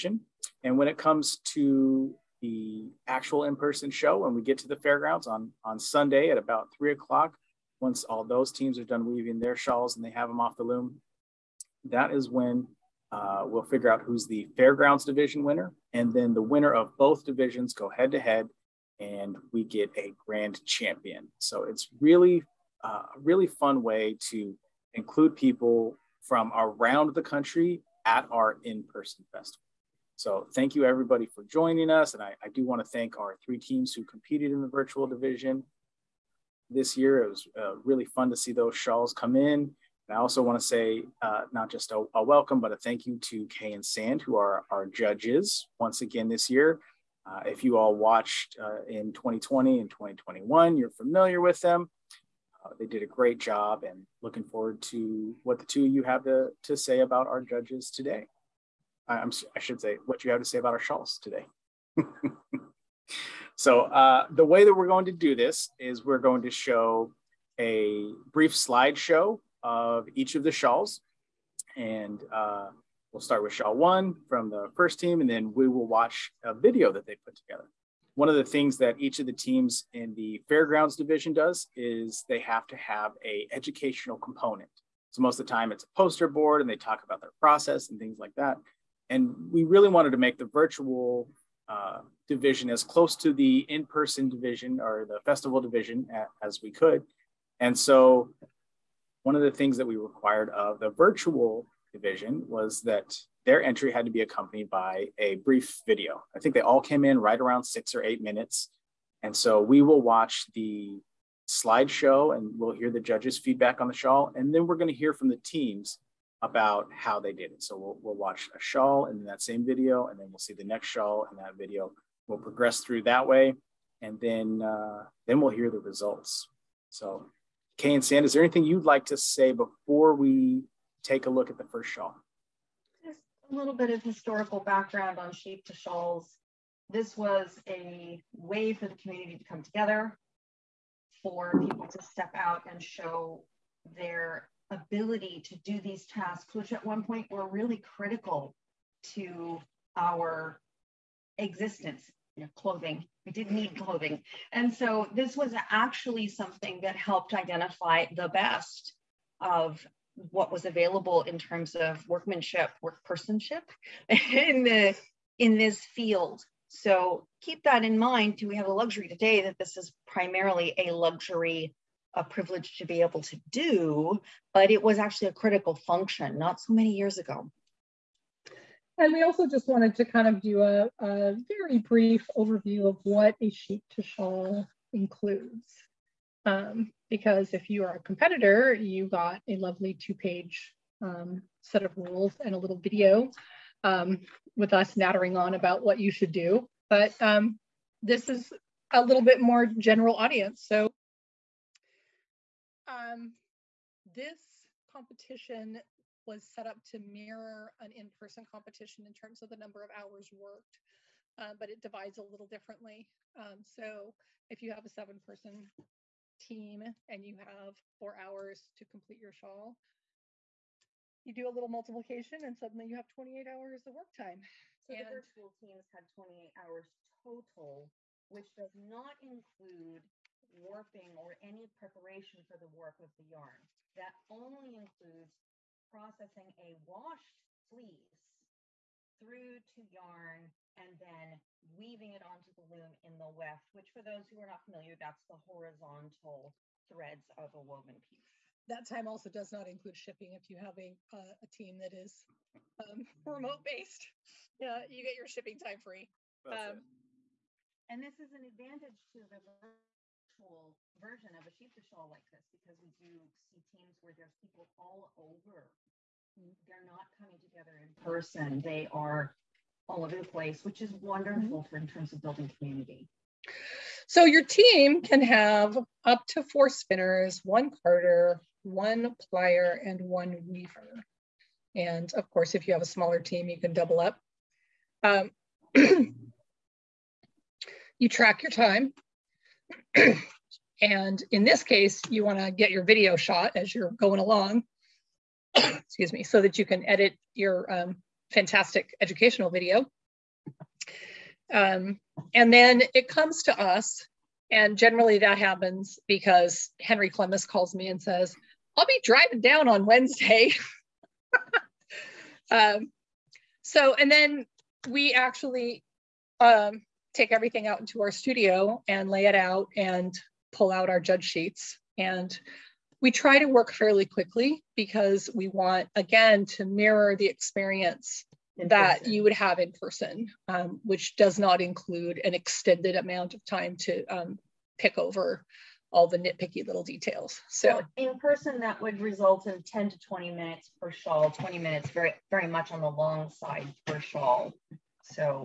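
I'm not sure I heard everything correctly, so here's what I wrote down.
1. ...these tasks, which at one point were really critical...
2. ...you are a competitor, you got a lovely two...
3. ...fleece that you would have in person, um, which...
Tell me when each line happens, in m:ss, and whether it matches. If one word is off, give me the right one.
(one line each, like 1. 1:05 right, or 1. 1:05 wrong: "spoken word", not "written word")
1. 2:25 right
2. 3:07 right
3. 5:27 wrong: "experience", not "fleece".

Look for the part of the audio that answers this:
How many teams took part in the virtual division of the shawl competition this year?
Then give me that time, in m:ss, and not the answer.
0:33.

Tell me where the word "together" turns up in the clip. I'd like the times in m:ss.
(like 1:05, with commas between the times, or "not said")
1:17, 2:19, 4:27.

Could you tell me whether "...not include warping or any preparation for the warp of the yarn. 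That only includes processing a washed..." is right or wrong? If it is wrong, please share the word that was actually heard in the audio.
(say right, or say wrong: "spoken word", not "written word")
right.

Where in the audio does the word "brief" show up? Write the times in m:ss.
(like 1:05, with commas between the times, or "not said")
1:08, 1:45, 3:01.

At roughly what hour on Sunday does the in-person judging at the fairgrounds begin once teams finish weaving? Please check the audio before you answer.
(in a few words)
3 o'clock.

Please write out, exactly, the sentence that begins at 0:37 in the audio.
It was uh, really fun to see those shawls come in.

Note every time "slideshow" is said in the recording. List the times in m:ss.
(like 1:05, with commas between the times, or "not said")
1:08, 1:51.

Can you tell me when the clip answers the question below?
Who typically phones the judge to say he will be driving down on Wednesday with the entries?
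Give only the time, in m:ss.
5:06.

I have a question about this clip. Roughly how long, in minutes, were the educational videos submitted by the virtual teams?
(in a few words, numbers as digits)
6 or 8 minutes.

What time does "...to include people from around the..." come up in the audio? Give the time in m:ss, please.
0:24.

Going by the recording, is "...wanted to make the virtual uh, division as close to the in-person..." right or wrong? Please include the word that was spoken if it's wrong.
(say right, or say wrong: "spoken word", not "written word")
right.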